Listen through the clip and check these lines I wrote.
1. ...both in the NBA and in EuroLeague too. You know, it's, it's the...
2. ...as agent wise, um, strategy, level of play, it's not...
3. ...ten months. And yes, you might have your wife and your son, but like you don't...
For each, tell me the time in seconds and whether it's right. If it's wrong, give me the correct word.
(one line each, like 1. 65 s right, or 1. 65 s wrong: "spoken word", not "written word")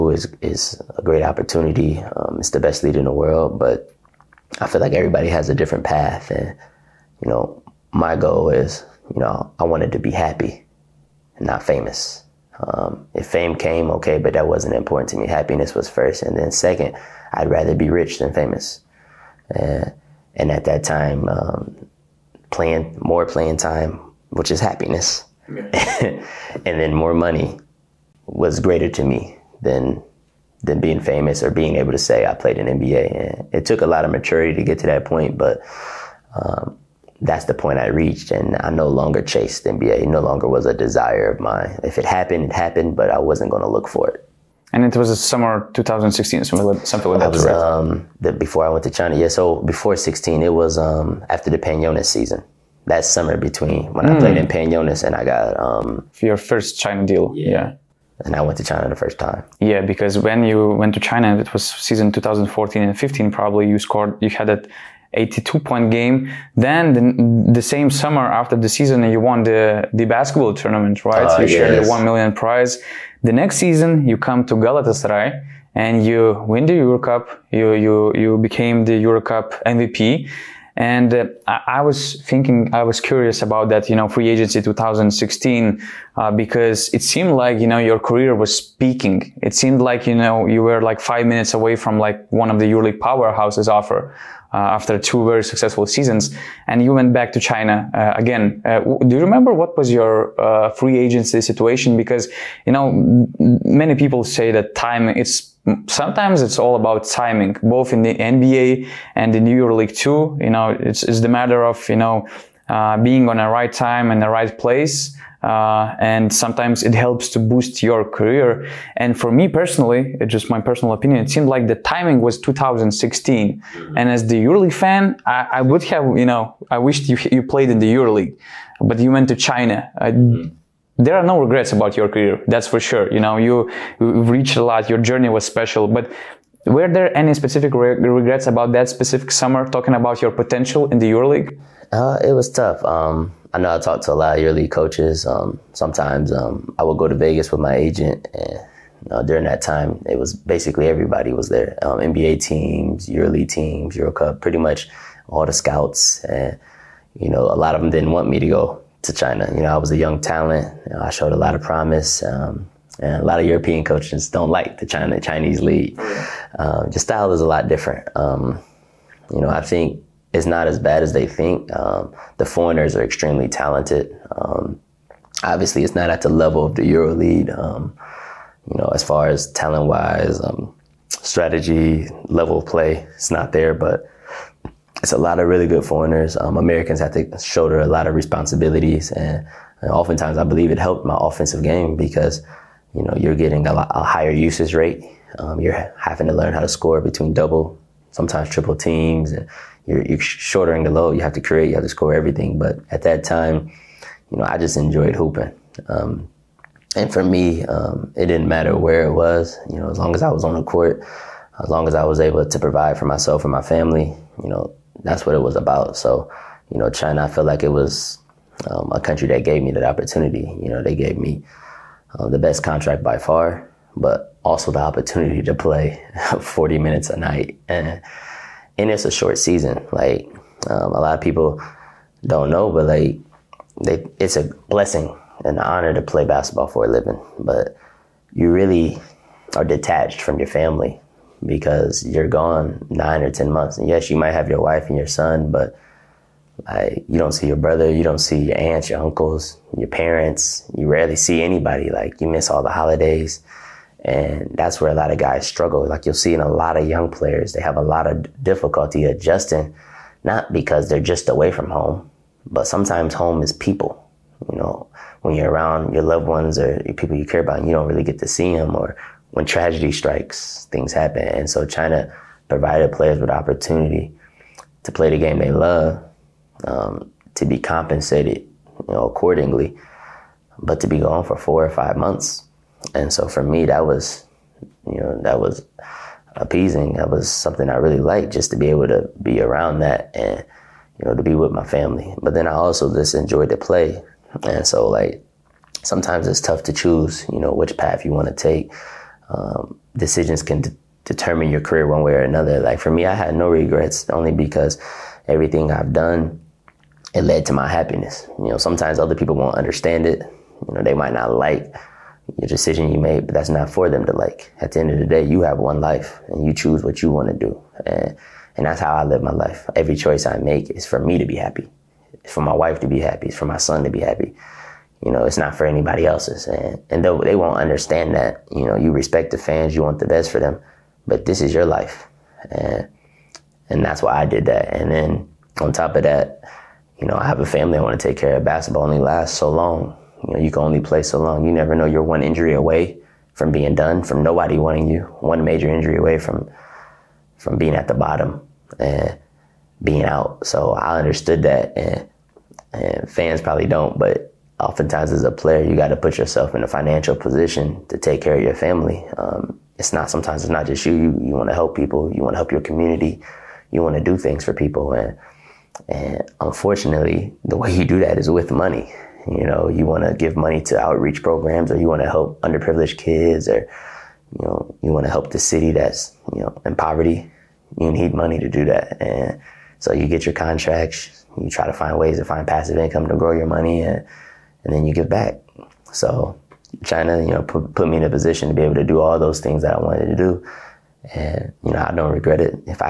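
1. 107 s right
2. 179 s wrong: "talent", not "agent"
3. 243 s right.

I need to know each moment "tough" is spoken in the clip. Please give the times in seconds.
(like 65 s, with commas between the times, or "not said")
142 s, 296 s.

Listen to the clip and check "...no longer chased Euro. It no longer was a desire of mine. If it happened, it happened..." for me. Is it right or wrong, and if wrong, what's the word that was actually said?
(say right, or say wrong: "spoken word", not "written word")
wrong: "NBA", not "Euro".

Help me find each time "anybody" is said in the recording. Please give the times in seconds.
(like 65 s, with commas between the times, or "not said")
251 s, 325 s.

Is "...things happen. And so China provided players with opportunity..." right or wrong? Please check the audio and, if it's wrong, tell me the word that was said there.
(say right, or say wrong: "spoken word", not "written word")
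right.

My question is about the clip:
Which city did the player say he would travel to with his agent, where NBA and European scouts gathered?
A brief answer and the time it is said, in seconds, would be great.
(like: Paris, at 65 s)
Vegas, at 147 s.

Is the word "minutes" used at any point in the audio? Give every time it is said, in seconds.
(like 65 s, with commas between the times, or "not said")
91 s, 226 s.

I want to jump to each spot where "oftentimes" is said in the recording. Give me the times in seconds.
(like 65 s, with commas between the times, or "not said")
189 s, 354 s.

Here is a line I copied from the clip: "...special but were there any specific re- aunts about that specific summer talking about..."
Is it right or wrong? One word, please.
wrong.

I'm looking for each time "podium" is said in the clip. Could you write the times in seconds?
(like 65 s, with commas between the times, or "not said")
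not said.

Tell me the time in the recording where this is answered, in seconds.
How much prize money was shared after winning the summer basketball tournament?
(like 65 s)
71 s.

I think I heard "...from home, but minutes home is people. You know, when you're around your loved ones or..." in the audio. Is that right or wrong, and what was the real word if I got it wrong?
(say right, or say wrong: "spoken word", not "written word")
wrong: "sometimes", not "minutes".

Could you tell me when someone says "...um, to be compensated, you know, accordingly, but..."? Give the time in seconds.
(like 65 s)
276 s.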